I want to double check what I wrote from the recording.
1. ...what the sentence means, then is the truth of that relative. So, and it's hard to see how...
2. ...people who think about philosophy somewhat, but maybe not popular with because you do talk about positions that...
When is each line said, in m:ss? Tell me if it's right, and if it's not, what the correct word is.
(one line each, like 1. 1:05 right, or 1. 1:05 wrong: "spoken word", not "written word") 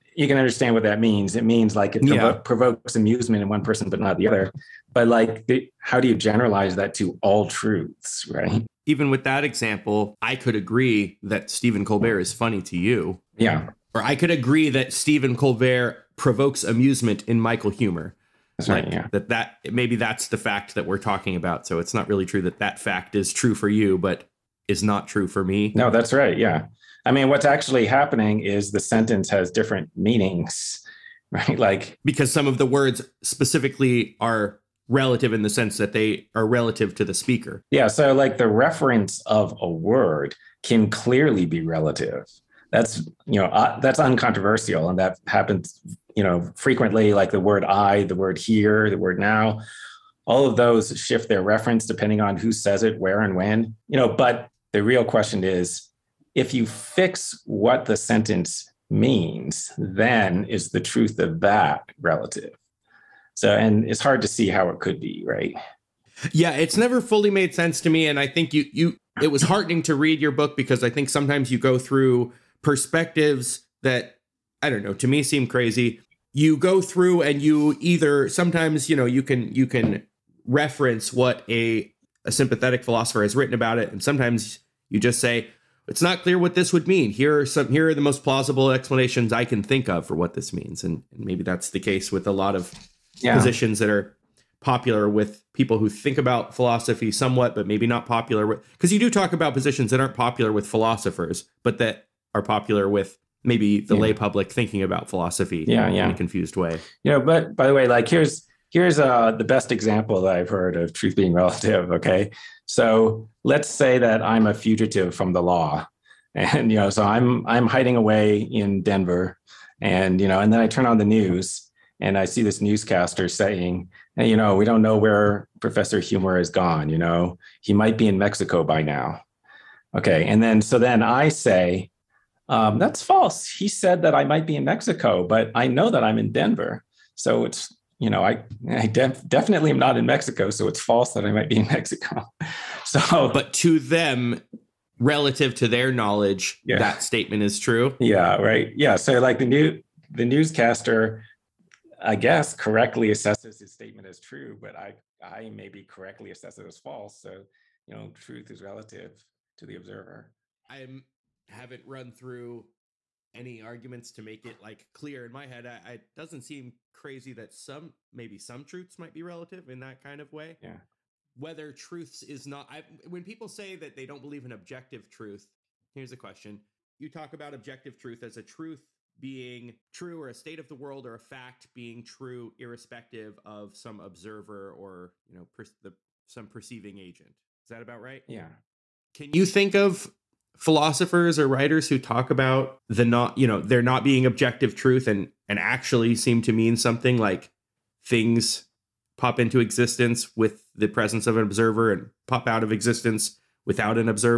1. 0:57 right
2. 1:35 right.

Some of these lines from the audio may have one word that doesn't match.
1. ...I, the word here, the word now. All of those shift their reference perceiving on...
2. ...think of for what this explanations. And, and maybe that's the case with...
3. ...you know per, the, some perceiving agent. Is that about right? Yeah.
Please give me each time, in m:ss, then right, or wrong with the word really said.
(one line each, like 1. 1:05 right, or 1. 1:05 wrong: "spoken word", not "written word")
1. 0:47 wrong: "depending", not "perceiving"
2. 1:29 wrong: "means", not "explanations"
3. 3:05 right.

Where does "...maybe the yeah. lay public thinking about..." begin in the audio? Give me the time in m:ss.
1:43.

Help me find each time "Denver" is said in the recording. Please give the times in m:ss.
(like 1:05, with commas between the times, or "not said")
1:58, 2:16.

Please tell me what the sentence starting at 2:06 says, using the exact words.
You know, he might be in Mexico by now.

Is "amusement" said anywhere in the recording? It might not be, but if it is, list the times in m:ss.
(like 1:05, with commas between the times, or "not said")
0:02, 0:16.